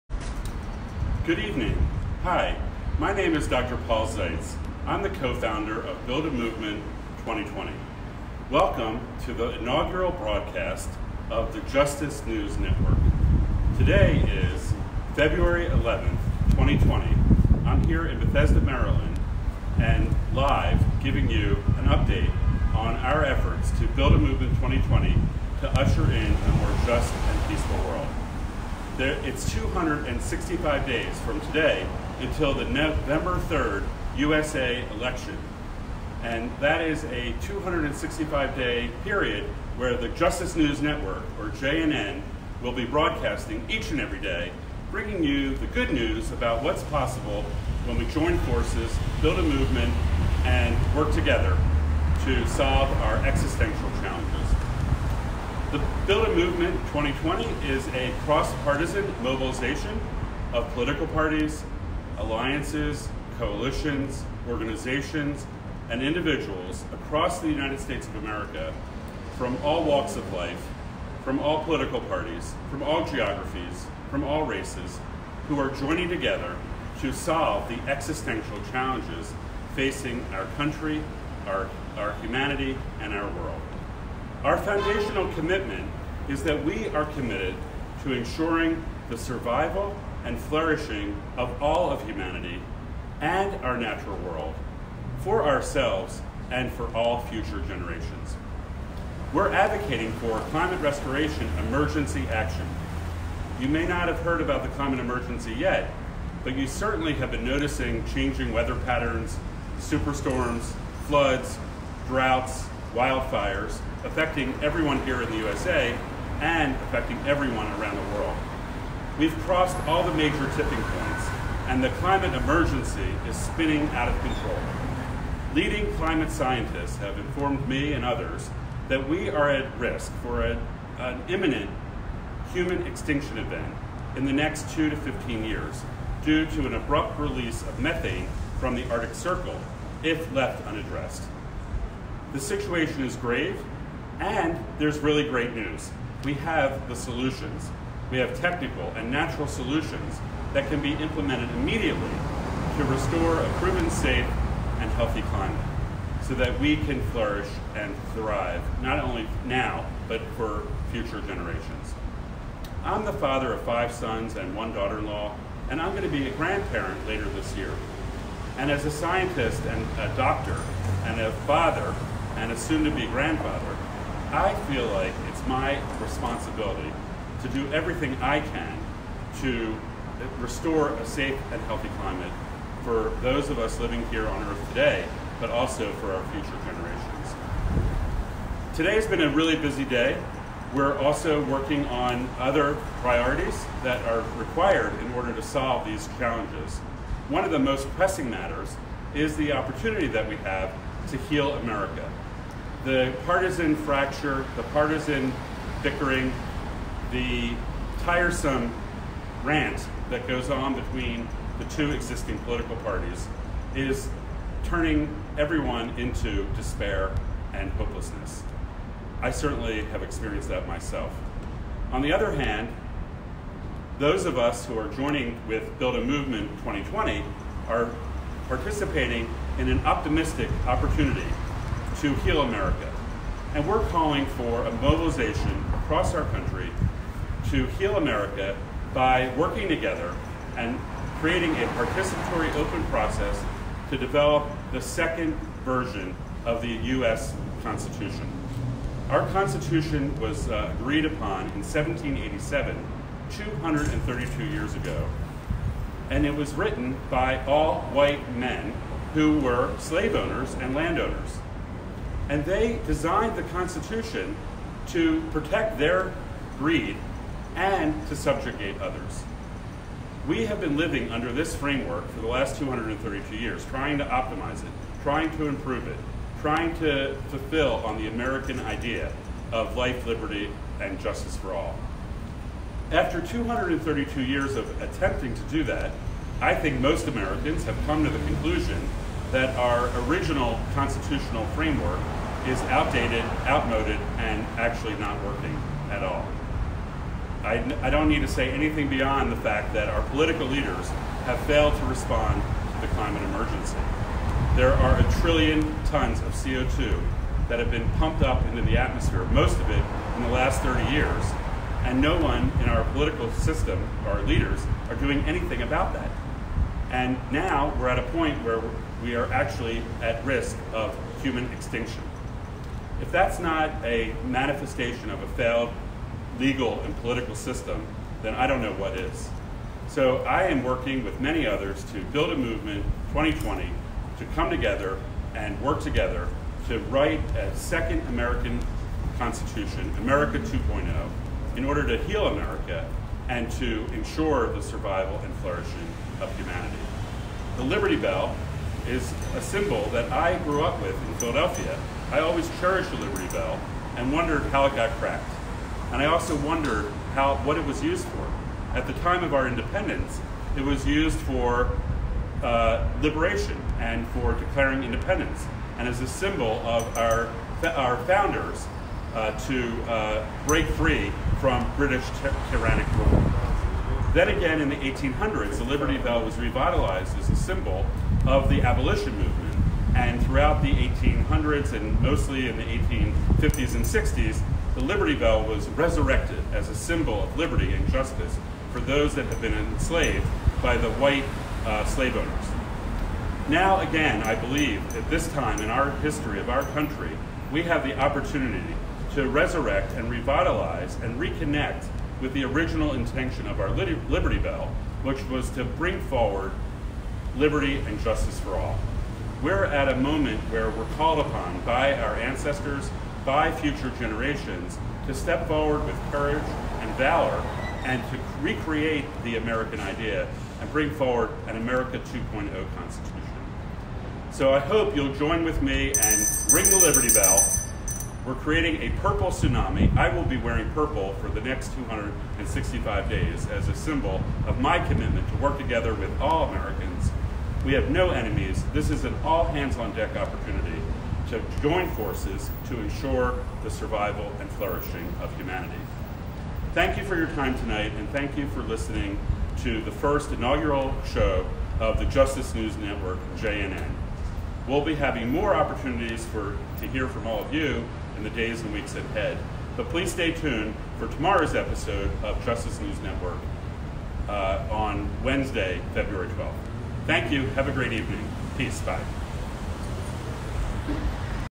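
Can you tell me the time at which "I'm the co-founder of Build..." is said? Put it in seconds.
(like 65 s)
4 s.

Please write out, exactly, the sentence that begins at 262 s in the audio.
And they designed the Constitution to protect their greed and to subjugate others.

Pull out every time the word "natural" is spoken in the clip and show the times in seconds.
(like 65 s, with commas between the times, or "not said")
93 s, 149 s.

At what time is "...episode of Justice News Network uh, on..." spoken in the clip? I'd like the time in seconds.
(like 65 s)
461 s.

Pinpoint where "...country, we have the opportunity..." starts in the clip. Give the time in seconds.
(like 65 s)
396 s.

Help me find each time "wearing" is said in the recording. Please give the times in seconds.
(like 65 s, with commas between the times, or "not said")
430 s.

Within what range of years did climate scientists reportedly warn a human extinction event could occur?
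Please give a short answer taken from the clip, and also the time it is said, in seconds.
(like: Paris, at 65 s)
2 to 15 years, at 134 s.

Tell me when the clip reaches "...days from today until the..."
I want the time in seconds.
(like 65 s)
30 s.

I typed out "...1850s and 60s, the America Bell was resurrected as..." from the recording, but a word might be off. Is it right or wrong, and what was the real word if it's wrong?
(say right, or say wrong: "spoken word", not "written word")
wrong: "Liberty", not "America".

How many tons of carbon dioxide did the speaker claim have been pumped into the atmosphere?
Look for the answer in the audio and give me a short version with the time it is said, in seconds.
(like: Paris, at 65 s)
a trillion, at 304 s.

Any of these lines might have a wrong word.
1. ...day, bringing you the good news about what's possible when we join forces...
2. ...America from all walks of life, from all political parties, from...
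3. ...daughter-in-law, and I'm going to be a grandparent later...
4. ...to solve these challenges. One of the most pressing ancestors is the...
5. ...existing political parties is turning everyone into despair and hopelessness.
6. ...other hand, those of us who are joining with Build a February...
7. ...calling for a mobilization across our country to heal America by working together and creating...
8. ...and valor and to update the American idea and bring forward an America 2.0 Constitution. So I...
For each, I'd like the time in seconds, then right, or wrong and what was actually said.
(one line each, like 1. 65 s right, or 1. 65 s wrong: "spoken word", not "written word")
1. 44 s right
2. 68 s right
3. 164 s right
4. 195 s wrong: "matters", not "ancestors"
5. 211 s right
6. 222 s wrong: "Movement", not "February"
7. 233 s right
8. 416 s wrong: "recreate", not "update".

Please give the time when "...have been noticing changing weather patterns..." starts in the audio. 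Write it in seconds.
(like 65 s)
107 s.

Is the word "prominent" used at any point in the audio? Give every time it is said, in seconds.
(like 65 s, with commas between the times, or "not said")
not said.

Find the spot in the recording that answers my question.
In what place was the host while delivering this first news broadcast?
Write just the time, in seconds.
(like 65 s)
18 s.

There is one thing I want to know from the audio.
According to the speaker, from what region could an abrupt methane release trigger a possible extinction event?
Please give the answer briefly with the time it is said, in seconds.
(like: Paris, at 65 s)
Arctic Circle, at 138 s.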